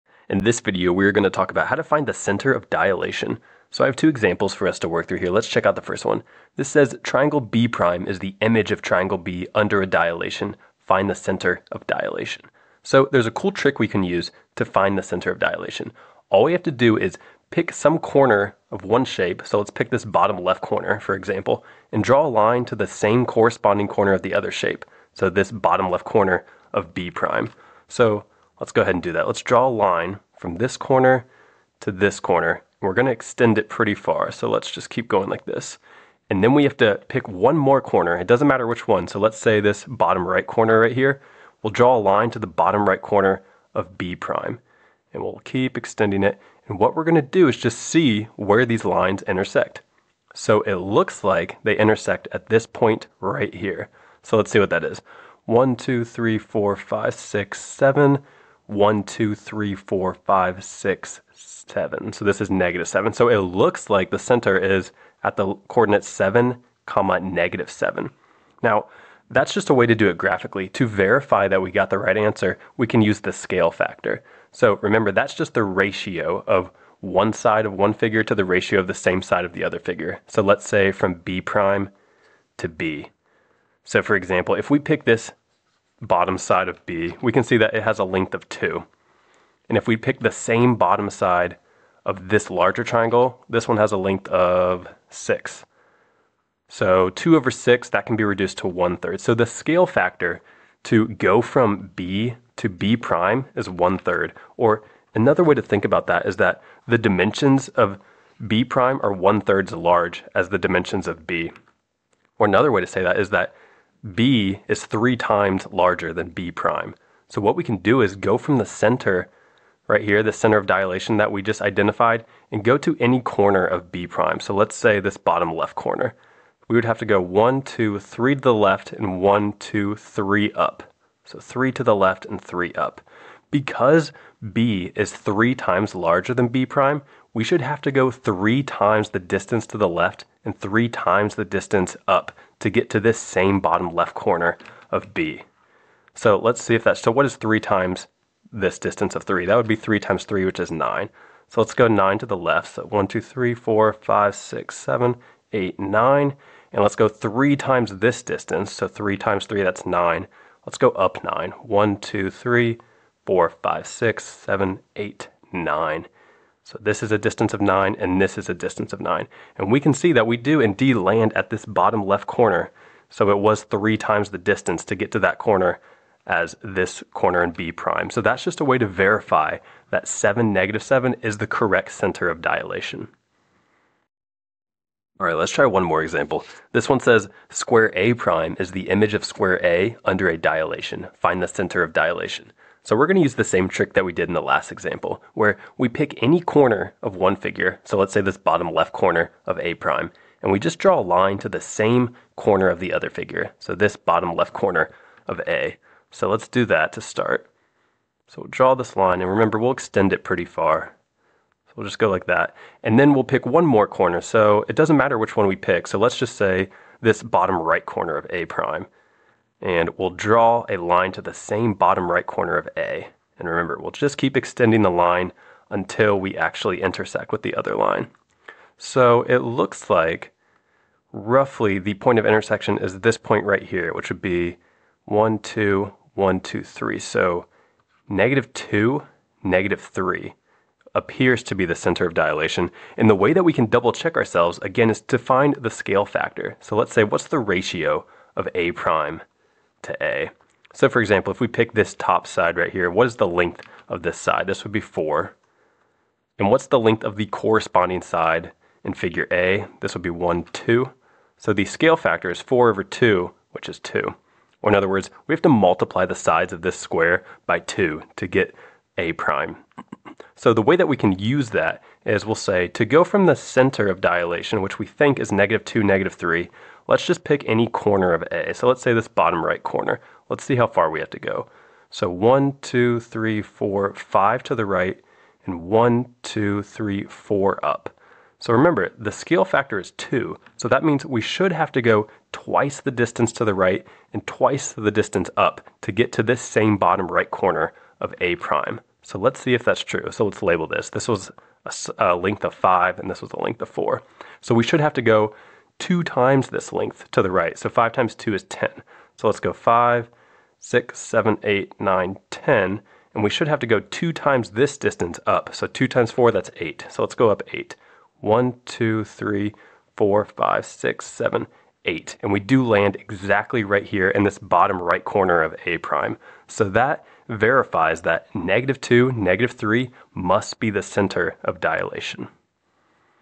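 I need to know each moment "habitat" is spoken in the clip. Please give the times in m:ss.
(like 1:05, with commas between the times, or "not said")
not said.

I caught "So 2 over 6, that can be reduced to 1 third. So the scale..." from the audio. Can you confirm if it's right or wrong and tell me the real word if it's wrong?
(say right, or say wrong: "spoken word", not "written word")
right.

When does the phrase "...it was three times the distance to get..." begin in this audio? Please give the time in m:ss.
2:53.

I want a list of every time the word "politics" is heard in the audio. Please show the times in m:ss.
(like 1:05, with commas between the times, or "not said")
not said.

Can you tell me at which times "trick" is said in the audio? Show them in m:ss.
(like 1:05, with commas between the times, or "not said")
0:13, 3:13.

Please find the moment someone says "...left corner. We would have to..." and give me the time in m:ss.
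2:05.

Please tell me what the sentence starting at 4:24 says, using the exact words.
Or in other words, we have to multiply the sides of this square by 2 to get A prime.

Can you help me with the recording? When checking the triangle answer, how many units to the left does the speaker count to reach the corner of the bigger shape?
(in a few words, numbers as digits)
9.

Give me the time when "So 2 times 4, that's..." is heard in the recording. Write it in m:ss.
5:15.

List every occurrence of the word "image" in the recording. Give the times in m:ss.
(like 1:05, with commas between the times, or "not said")
0:08, 3:08.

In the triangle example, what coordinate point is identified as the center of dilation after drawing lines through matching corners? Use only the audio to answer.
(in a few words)
(7, -7).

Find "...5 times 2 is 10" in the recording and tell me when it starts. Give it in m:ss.
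5:07.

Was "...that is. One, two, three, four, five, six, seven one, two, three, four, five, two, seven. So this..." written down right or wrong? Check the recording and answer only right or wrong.
wrong.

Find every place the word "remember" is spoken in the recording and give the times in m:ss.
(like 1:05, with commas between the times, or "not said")
1:14, 3:29, 3:43, 4:48.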